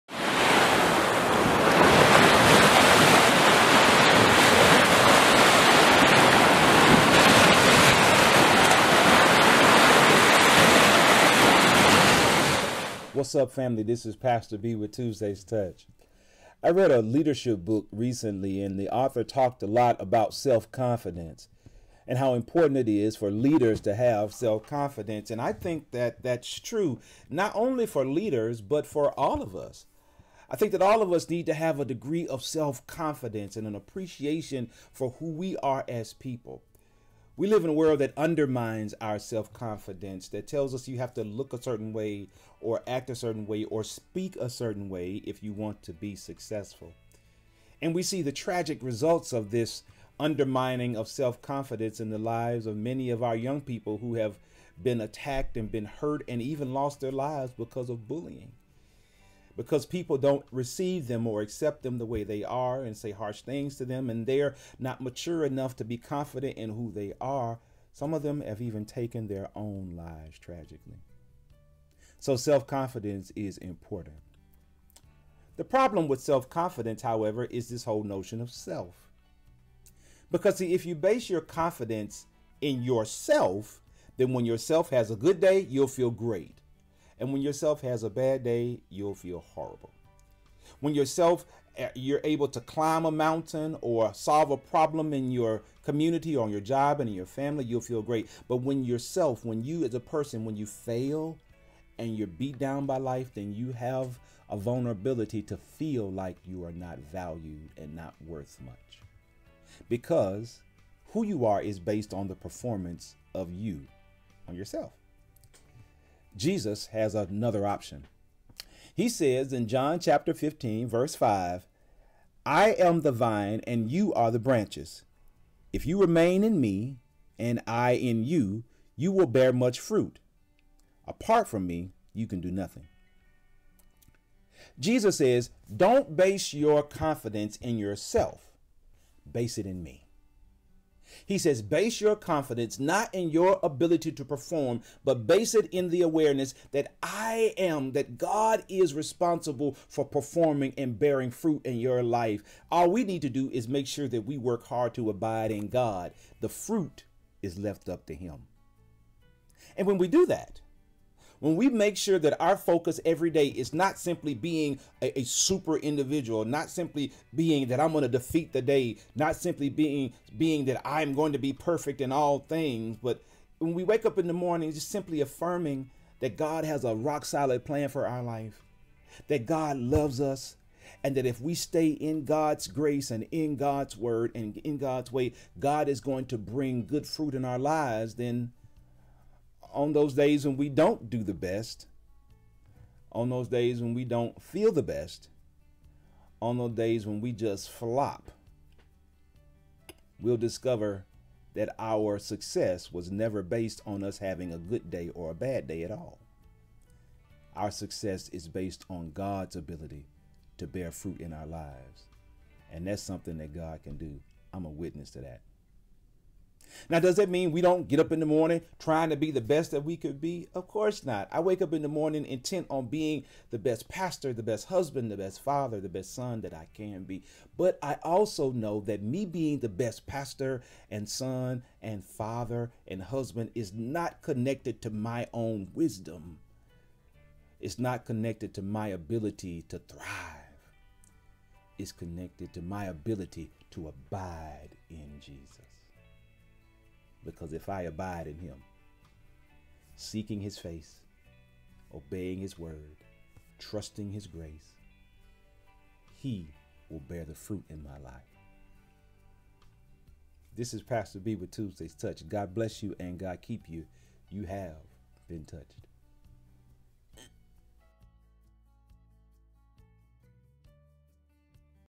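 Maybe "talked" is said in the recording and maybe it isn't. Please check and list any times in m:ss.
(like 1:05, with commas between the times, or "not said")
0:19.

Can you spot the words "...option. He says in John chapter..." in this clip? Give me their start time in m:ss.
1:57.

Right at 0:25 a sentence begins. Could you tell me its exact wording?
And I think that that's true, not only for leaders, but for all of us.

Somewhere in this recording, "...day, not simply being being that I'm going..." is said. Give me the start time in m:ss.
2:48.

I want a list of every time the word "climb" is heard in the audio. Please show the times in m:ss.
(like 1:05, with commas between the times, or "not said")
1:32.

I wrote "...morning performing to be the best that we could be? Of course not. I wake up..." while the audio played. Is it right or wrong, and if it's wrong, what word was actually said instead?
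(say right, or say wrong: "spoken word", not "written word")
wrong: "trying", not "performing".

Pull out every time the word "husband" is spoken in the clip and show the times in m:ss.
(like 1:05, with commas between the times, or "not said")
3:44, 3:53.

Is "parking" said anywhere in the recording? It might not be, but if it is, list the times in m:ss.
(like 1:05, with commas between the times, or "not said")
not said.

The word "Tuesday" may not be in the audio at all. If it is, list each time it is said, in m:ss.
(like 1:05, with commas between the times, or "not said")
0:14, 4:21.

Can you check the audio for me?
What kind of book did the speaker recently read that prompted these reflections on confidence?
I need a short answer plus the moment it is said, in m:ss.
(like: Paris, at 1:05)
leadership book, at 0:17.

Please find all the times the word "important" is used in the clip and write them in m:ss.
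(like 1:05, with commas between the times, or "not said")
0:22, 1:13.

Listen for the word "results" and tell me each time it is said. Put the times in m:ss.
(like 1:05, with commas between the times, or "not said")
0:48.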